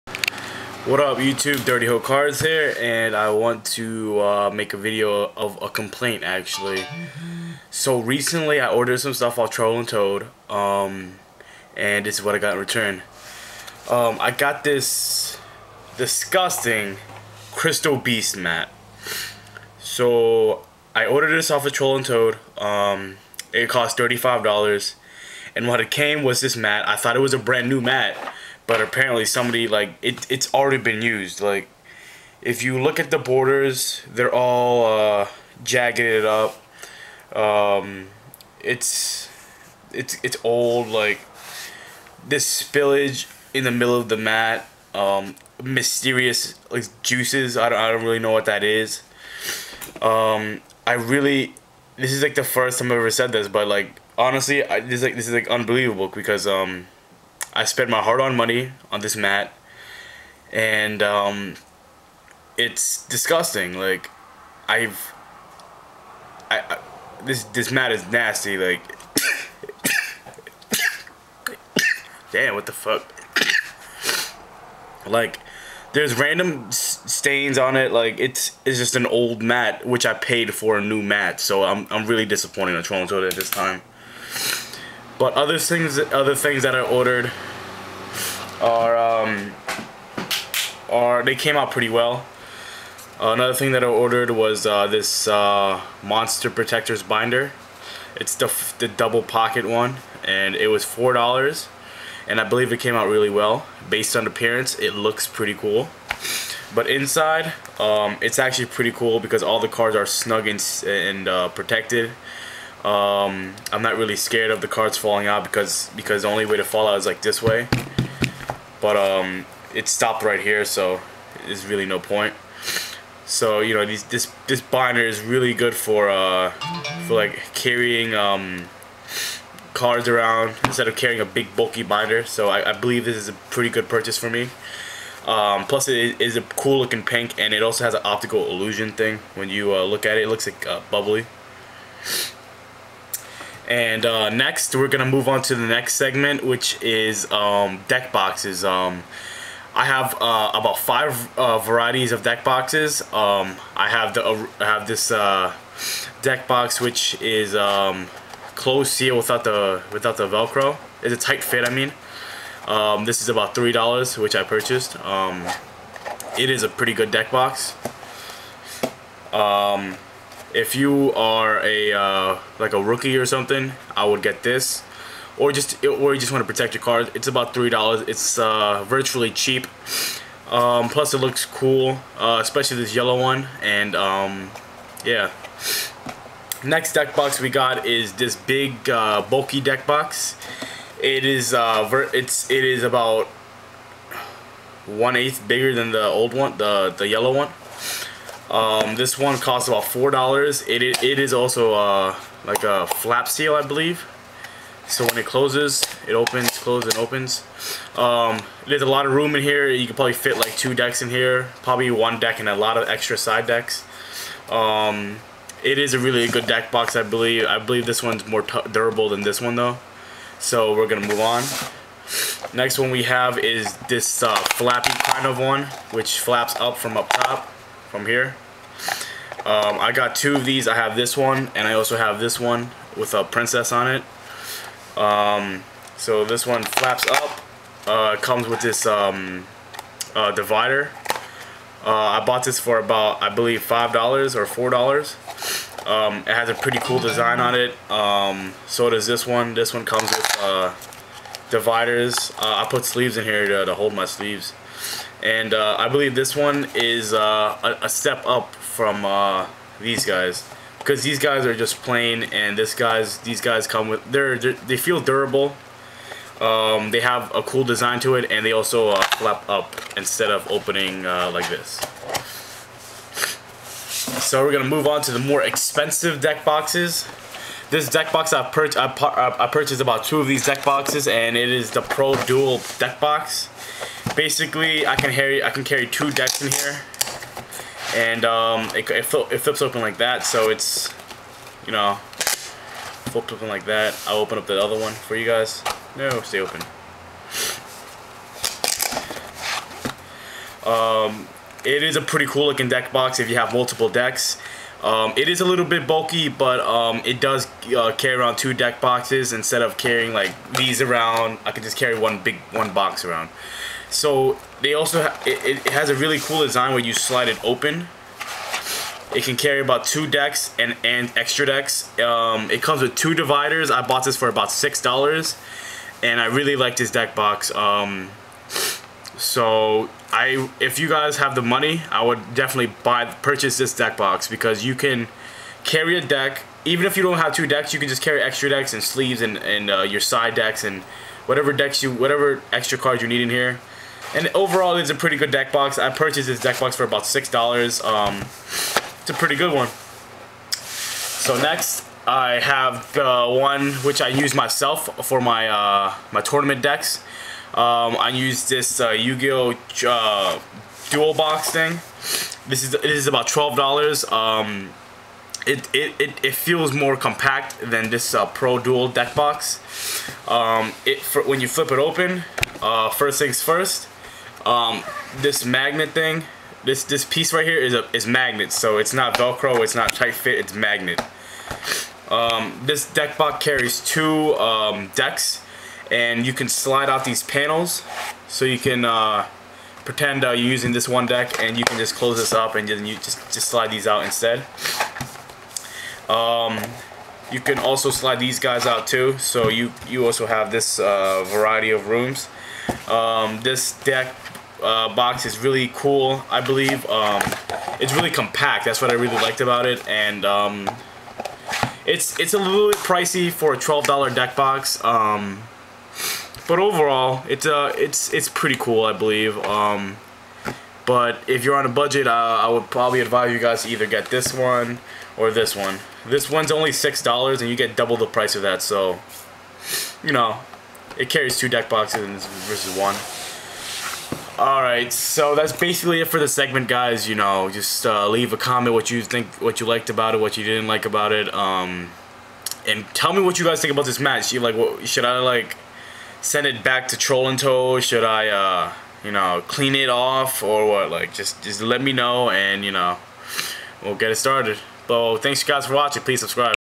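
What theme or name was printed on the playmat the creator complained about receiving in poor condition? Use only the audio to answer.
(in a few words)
Crystal Beast.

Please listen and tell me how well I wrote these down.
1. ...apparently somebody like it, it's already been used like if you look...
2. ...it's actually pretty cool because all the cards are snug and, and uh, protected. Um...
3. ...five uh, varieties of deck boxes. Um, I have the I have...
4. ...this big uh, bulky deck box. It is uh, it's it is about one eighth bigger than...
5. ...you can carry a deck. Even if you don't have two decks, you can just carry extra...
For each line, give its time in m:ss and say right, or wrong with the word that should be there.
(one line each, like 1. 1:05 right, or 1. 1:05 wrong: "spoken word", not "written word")
1. 0:28 right
2. 1:48 right
3. 2:30 right
4. 3:08 right
5. 5:34 right.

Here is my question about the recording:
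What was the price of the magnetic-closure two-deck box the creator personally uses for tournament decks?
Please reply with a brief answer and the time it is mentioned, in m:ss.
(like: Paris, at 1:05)
$12, at 6:03.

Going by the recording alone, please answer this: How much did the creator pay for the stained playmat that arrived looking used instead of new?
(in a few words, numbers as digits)
$35.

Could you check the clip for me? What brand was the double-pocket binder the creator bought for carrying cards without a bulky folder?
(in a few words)
Monster Protectors.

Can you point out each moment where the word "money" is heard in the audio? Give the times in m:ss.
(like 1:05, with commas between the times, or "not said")
0:58, 5:31.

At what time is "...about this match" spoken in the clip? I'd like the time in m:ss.
7:23.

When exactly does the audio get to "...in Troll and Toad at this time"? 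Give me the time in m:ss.
1:22.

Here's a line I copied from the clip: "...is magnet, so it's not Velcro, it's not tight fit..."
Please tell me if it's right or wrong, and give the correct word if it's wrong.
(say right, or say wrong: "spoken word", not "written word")
right.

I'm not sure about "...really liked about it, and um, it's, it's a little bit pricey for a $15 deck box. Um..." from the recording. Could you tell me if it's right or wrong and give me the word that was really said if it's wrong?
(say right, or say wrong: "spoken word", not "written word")
wrong: "12", not "15".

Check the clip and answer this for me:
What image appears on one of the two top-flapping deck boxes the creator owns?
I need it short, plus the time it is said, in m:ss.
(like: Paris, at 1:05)
a princess, at 3:53.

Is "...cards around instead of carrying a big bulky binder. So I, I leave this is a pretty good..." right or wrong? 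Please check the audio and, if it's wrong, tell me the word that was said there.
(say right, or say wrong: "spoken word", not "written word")
wrong: "believe", not "leave".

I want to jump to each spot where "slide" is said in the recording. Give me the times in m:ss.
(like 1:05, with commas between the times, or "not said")
5:16, 6:26, 6:33, 6:37.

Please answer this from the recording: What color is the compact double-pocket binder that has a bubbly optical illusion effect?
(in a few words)
pink.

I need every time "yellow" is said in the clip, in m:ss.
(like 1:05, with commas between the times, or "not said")
3:02, 3:17.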